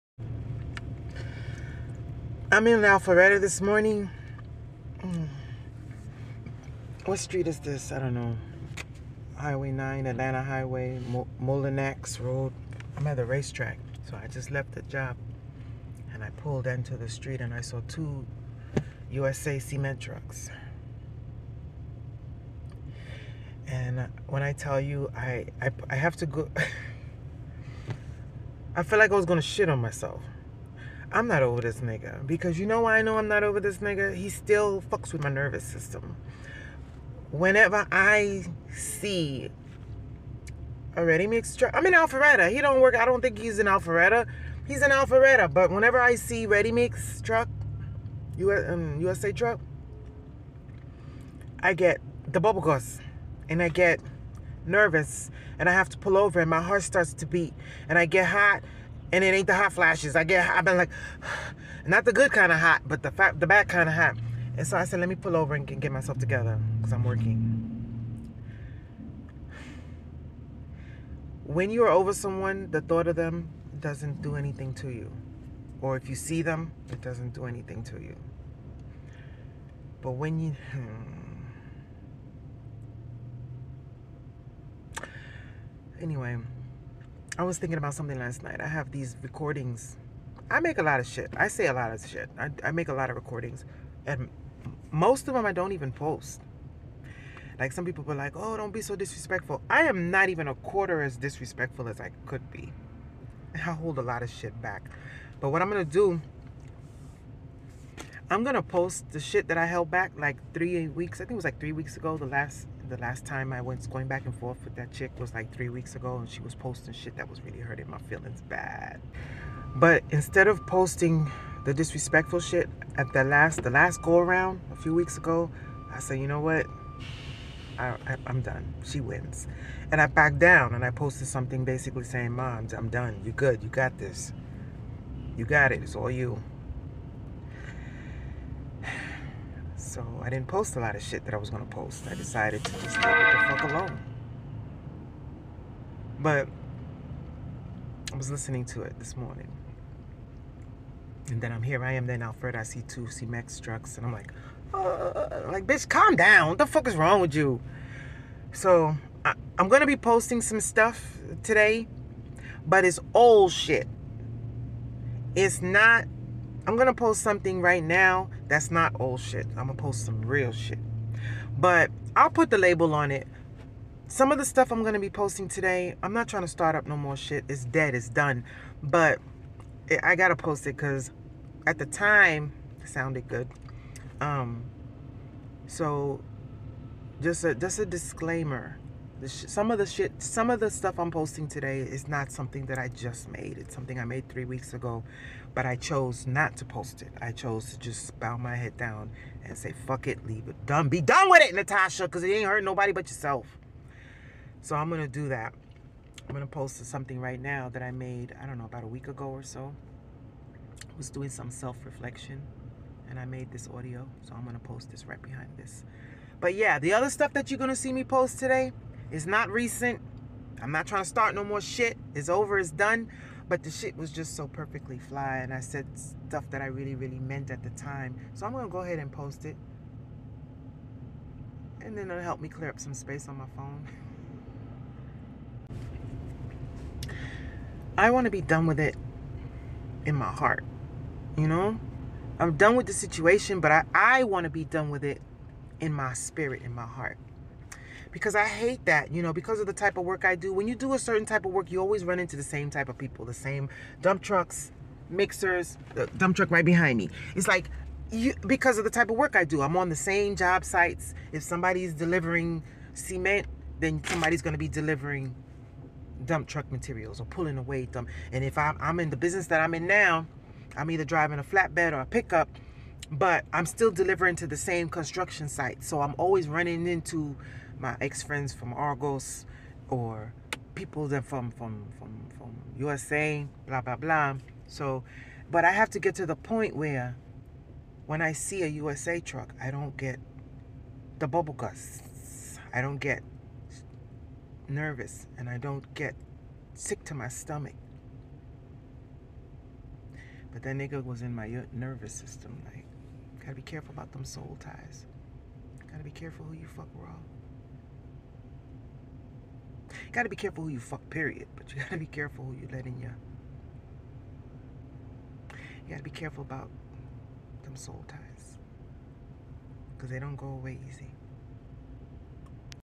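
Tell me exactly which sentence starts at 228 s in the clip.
So I'm gonna go ahead and post it.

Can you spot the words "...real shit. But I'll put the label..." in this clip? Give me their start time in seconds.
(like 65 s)
170 s.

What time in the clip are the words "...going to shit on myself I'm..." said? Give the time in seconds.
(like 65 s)
29 s.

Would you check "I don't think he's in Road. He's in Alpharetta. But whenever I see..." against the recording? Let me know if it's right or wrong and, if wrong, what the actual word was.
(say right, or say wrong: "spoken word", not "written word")
wrong: "Alpharetta", not "Road".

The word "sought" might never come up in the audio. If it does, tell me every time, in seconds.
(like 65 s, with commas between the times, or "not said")
not said.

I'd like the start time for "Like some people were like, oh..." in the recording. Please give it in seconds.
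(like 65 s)
97 s.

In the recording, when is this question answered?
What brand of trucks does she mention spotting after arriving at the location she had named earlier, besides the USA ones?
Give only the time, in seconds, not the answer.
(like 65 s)
153 s.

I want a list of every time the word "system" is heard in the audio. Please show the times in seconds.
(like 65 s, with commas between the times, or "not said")
35 s, 302 s.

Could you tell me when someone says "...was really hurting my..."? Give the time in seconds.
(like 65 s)
117 s.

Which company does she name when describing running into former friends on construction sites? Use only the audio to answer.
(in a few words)
Argos.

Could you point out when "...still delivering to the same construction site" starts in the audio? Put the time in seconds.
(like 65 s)
273 s.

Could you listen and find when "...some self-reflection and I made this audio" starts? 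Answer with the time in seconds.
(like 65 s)
211 s.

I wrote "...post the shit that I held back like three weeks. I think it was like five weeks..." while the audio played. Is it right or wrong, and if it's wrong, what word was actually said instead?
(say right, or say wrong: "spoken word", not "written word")
wrong: "three", not "five".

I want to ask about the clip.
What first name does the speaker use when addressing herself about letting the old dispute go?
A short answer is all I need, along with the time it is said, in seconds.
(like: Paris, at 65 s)
Natasha, at 201 s.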